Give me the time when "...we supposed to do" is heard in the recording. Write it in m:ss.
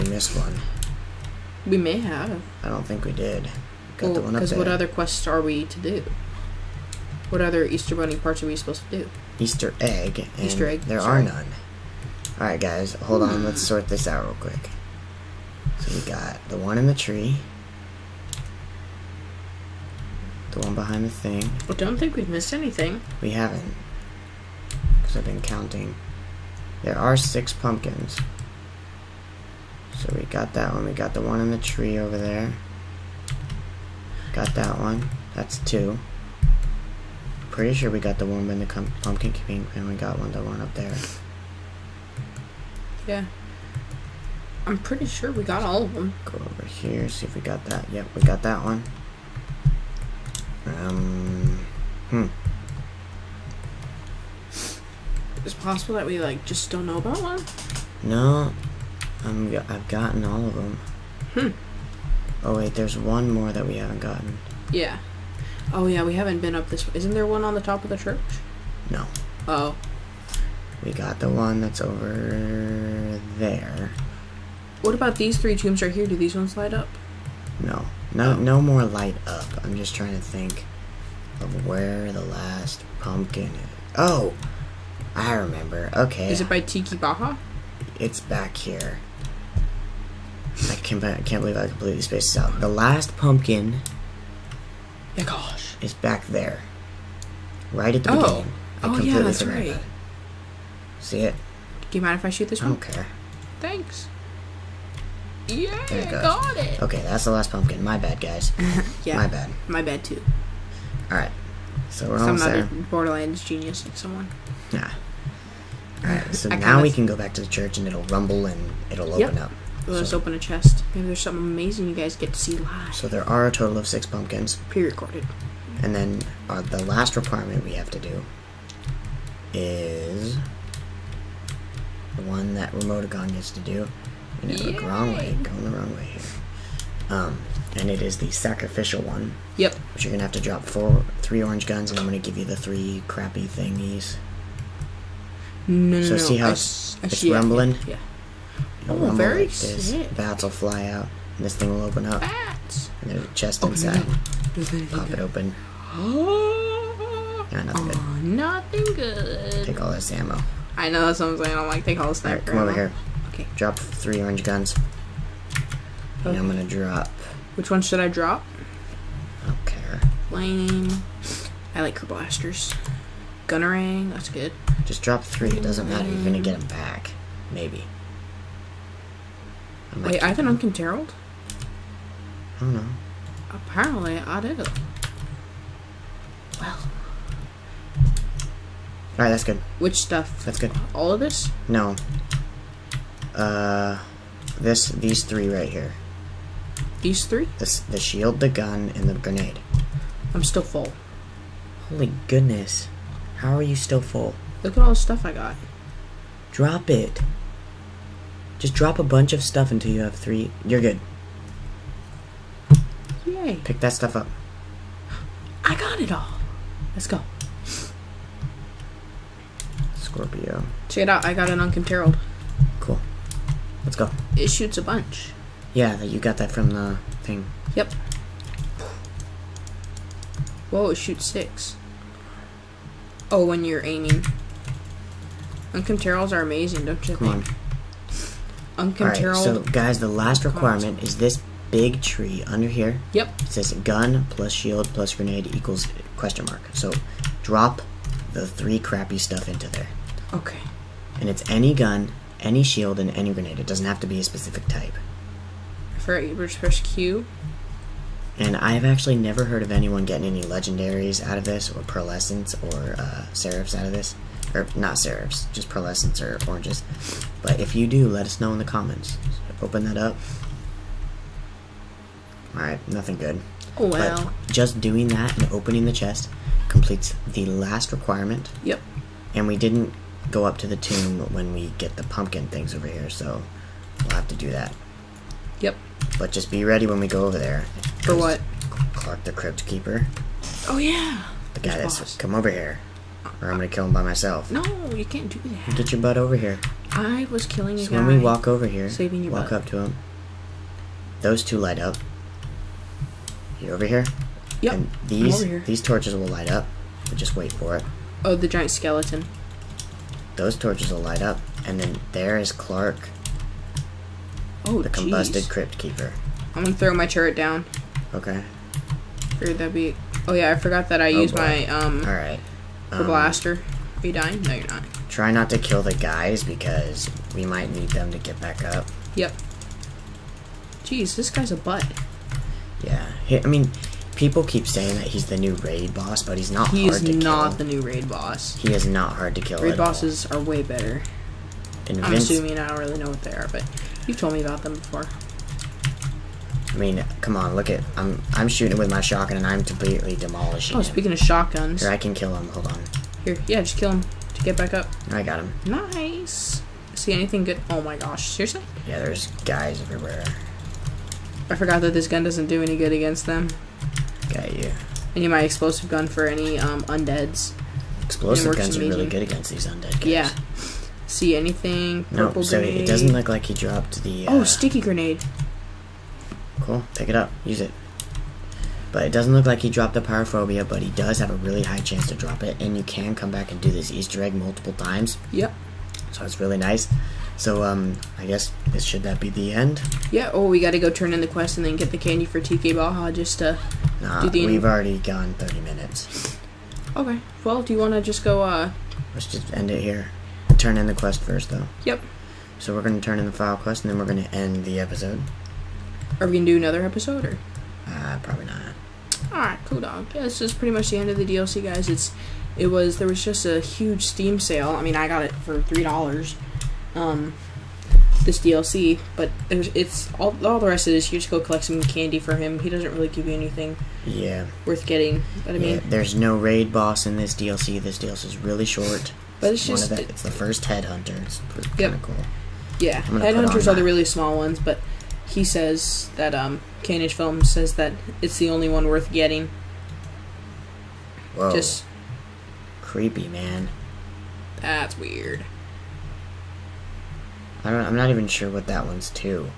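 0:08.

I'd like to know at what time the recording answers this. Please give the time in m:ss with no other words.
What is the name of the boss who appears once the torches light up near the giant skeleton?
4:48.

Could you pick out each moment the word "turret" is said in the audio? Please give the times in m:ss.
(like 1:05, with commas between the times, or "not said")
5:17.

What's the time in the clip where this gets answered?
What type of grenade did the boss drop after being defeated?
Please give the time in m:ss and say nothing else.
6:14.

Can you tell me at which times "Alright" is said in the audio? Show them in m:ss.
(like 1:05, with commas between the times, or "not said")
1:51, 1:56, 3:09, 4:32, 6:49.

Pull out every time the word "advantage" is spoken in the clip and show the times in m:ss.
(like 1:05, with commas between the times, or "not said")
not said.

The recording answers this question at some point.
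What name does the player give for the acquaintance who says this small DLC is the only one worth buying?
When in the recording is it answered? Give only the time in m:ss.
7:16.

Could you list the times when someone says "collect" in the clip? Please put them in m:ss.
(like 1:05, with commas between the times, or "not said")
7:01.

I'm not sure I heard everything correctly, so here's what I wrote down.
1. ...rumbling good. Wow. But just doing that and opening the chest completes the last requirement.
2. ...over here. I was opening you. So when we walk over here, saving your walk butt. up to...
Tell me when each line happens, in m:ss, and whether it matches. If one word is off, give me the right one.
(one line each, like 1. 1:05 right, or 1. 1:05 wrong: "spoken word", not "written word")
1. 4:32 wrong: "nothing", not "rumbling"
2. 4:56 wrong: "killing", not "opening".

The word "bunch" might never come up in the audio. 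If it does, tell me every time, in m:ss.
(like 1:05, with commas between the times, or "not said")
3:29, 3:44.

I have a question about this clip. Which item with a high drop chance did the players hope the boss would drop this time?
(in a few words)
Pyrophobia.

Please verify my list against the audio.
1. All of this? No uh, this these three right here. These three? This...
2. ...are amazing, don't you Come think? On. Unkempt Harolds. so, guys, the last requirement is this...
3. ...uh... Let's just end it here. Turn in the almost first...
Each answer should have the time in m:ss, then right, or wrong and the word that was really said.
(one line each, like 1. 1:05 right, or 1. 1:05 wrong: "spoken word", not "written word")
1. 3:10 right
2. 3:56 right
3. 6:38 wrong: "quest", not "almost".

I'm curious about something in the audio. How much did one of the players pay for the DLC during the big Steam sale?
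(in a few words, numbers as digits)
$3.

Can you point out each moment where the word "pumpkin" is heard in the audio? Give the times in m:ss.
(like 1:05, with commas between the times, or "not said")
0:27, 0:38, 1:22, 1:33, 1:47, 2:04, 4:42.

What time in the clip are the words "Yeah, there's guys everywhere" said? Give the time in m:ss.
5:58.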